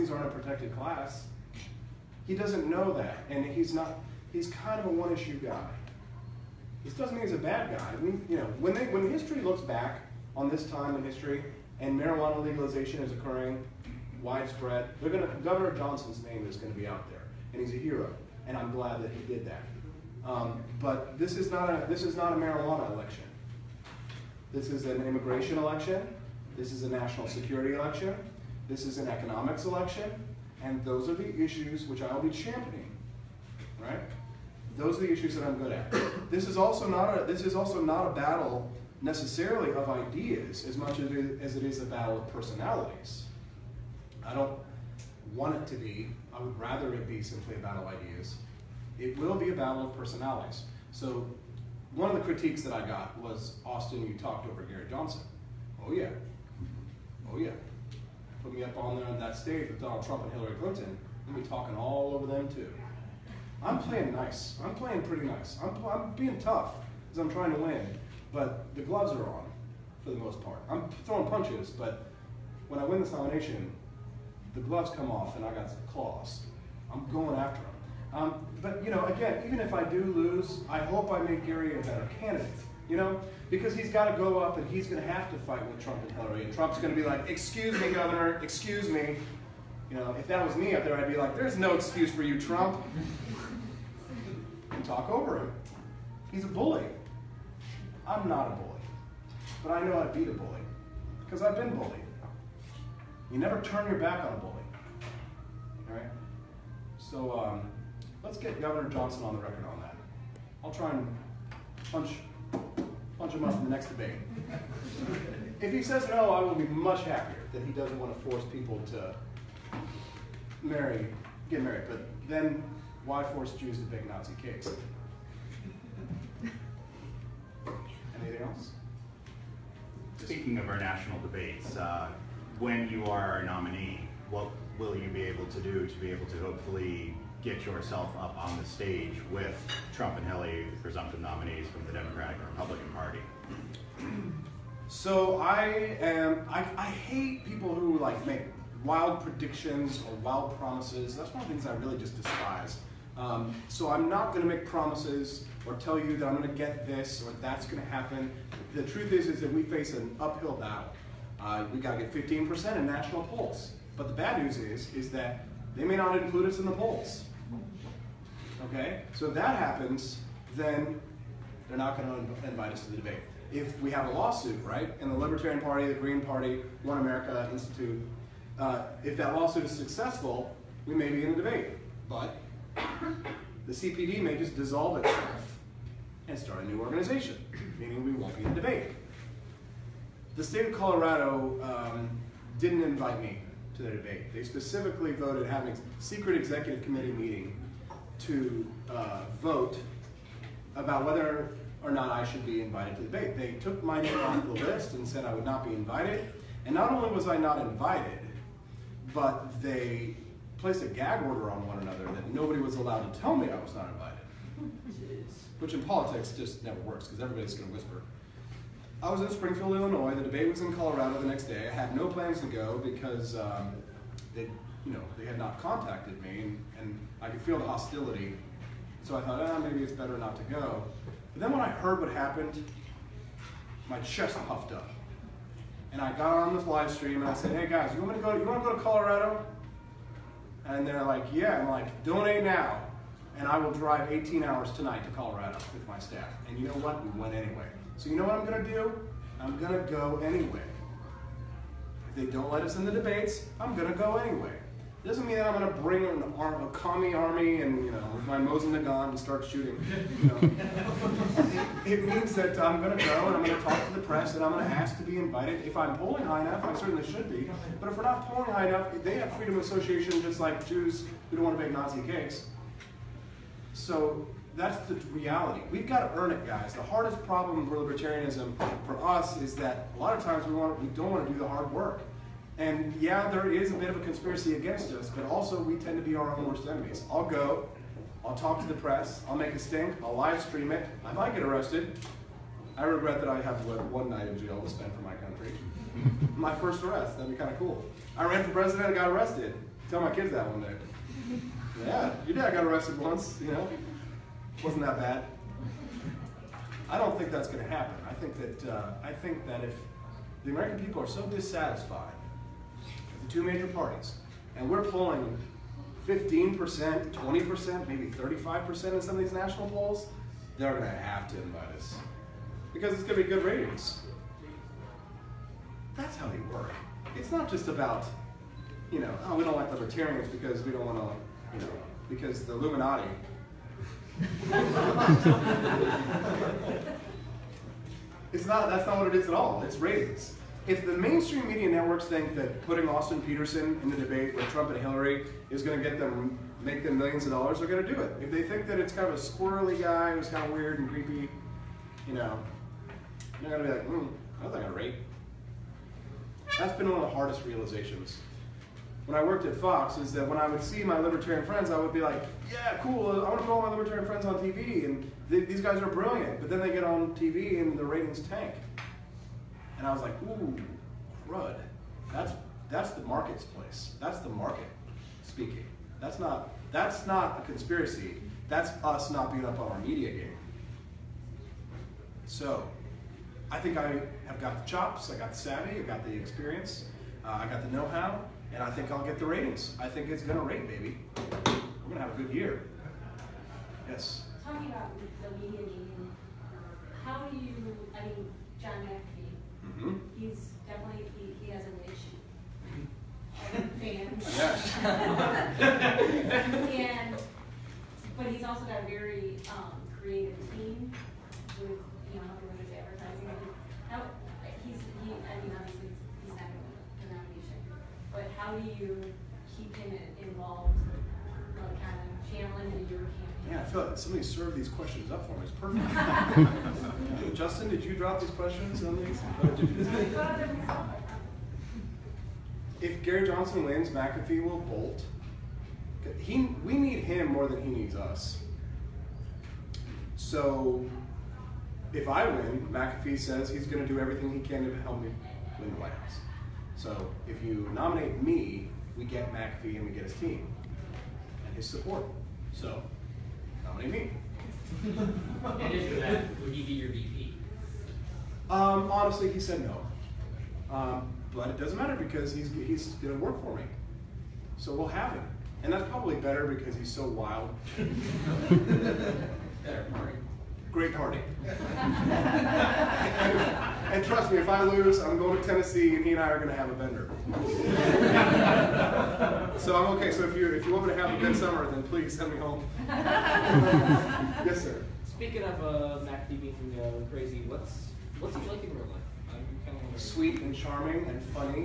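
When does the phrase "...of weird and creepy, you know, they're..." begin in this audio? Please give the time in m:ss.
5:50.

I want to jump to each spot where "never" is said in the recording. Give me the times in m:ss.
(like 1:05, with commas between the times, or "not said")
1:43, 3:36.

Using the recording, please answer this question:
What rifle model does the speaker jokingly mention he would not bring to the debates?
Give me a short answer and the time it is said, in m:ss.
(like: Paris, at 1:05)
Mosin Nagant, at 4:18.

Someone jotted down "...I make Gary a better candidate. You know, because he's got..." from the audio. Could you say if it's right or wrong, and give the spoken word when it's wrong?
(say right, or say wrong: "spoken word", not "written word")
right.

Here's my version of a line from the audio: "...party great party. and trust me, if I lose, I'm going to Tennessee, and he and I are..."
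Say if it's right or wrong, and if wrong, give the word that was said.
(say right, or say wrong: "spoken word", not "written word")
right.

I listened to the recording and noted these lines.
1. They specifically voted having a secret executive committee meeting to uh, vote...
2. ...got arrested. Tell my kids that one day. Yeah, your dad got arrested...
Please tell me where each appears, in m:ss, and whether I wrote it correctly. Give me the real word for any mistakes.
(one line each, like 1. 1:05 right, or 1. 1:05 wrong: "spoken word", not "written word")
1. 3:14 right
2. 4:58 right.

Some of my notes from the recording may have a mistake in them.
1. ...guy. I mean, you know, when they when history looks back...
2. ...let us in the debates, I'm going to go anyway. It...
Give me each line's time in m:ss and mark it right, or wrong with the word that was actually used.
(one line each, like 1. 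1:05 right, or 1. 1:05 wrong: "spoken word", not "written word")
1. 0:07 right
2. 4:12 right.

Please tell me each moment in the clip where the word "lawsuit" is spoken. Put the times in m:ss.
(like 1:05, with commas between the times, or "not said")
2:54, 2:59.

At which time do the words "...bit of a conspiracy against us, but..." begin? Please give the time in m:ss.
4:43.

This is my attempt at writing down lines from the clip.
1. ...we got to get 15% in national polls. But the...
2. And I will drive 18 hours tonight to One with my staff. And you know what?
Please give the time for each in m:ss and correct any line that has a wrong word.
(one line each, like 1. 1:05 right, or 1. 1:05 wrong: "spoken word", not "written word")
1. 2:41 right
2. 4:03 wrong: "Colorado", not "One".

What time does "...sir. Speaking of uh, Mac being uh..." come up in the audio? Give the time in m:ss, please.
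8:04.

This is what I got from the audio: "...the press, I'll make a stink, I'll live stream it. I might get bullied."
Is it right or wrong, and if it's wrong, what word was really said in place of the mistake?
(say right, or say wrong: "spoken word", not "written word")
wrong: "arrested", not "bullied".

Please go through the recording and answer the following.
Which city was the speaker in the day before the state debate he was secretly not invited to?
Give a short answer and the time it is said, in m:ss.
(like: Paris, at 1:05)
Springfield, Illinois, at 3:39.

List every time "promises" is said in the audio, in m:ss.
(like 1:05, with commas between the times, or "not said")
2:30, 2:34.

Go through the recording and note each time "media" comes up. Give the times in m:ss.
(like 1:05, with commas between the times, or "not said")
5:41, 6:19, 6:35.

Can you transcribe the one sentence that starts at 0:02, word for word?
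He doesn't know that, and he's not.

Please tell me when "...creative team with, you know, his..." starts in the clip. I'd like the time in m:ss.
6:49.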